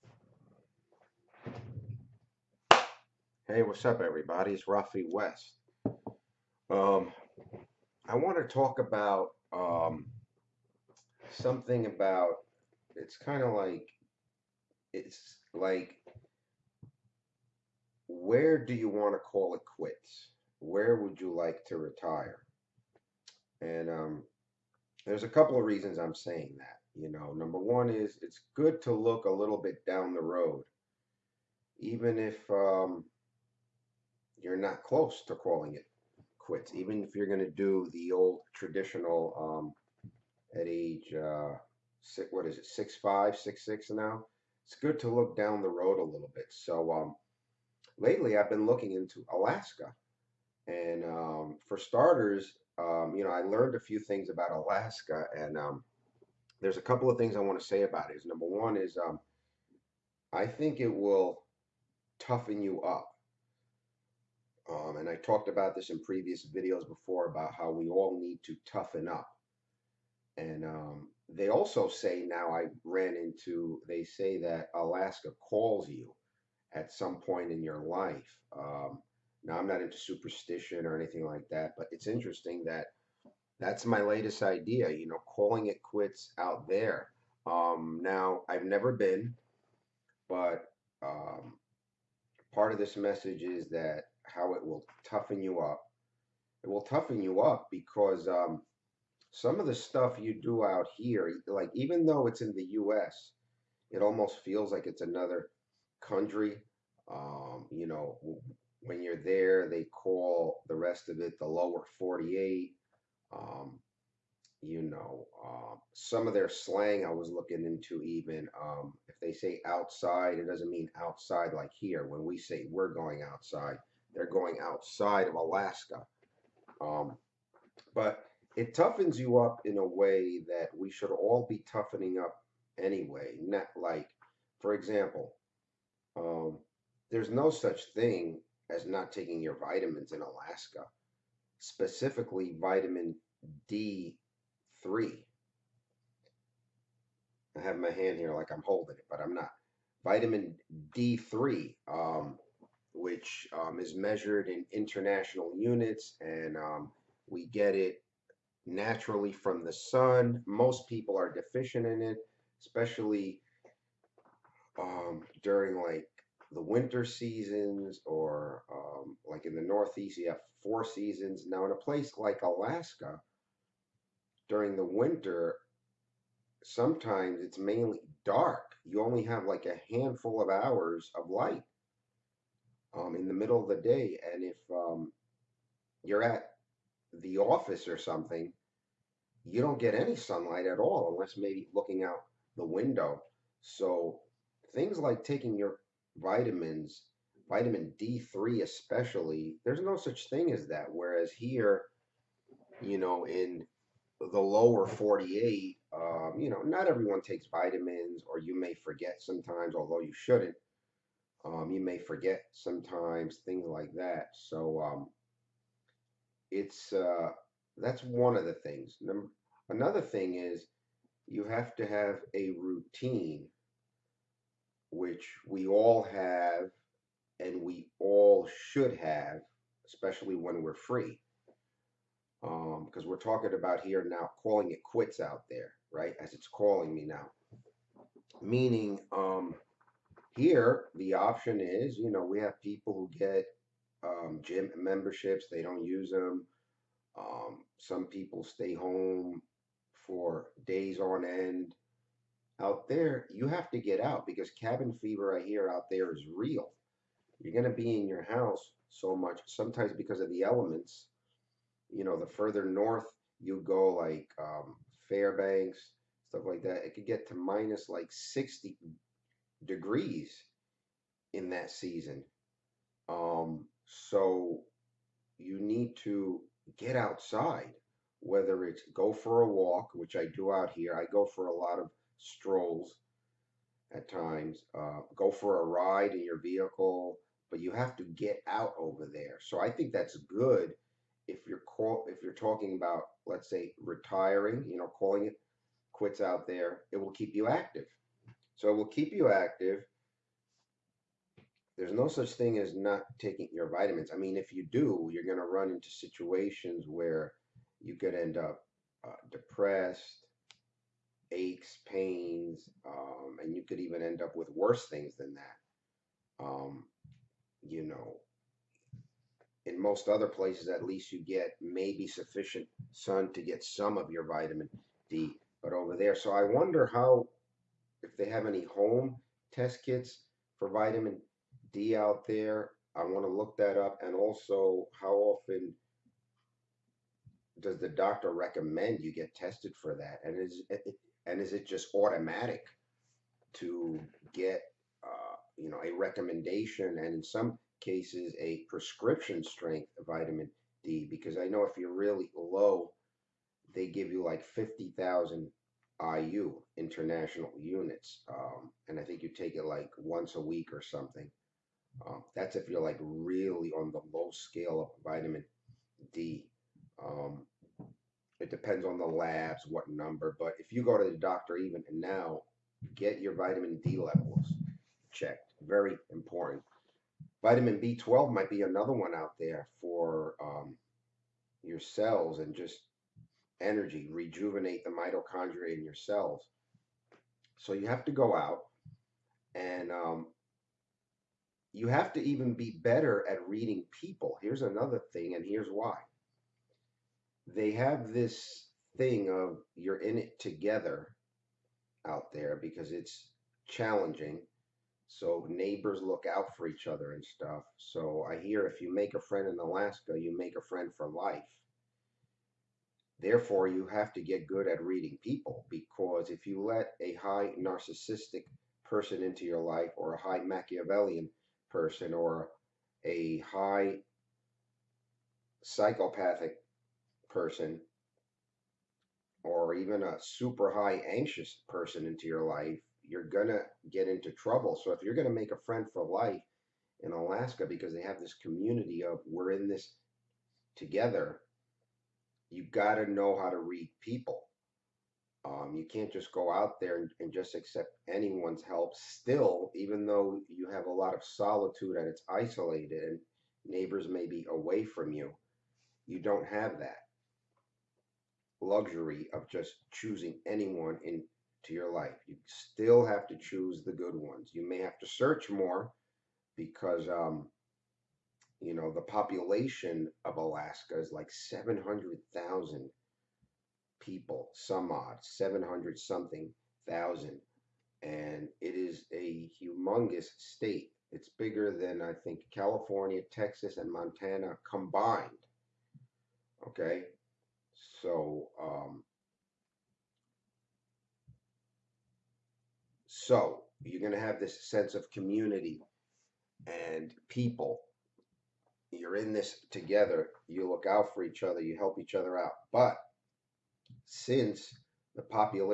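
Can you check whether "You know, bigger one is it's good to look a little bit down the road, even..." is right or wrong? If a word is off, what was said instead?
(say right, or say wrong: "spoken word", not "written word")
wrong: "number", not "bigger".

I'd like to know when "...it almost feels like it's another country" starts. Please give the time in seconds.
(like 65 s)
103 s.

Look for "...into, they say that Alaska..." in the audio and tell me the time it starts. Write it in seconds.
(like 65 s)
73 s.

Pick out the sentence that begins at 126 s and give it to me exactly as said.
Um, but it toughens you up in a way that we should all be toughening up anyway.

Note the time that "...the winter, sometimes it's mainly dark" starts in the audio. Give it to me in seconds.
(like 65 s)
174 s.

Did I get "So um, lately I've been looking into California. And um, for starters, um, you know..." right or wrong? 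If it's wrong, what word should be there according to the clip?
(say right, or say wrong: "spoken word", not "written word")
wrong: "Alaska", not "California".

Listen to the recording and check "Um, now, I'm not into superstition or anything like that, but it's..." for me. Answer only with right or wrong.
right.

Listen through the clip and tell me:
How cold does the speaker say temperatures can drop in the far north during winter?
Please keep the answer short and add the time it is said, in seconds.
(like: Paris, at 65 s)
minus 60 degrees, at 267 s.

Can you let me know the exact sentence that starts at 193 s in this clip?
So things like taking your vitamins, vitamin D3 especially, there's no such thing as that.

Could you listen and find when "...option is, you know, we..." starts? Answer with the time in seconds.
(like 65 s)
241 s.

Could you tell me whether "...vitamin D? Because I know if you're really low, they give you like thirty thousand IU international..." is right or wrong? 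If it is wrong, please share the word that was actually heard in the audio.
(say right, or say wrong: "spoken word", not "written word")
wrong: "fifty", not "thirty".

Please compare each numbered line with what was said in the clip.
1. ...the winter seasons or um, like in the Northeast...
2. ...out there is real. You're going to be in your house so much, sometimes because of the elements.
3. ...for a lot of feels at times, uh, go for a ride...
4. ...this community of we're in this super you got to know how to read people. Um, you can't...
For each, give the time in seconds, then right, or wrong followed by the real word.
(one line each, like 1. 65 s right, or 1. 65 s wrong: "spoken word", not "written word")
1. 166 s right
2. 255 s right
3. 281 s wrong: "strolls", not "feels"
4. 438 s wrong: "together", not "super".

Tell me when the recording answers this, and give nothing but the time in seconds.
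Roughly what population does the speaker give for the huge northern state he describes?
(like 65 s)
471 s.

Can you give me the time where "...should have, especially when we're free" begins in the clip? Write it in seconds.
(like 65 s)
228 s.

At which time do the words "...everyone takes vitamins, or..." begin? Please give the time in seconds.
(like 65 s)
206 s.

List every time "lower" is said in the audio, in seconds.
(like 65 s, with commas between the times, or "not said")
111 s, 204 s.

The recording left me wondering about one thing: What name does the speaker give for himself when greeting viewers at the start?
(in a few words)
Rafe West.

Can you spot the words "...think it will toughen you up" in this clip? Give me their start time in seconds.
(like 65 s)
60 s.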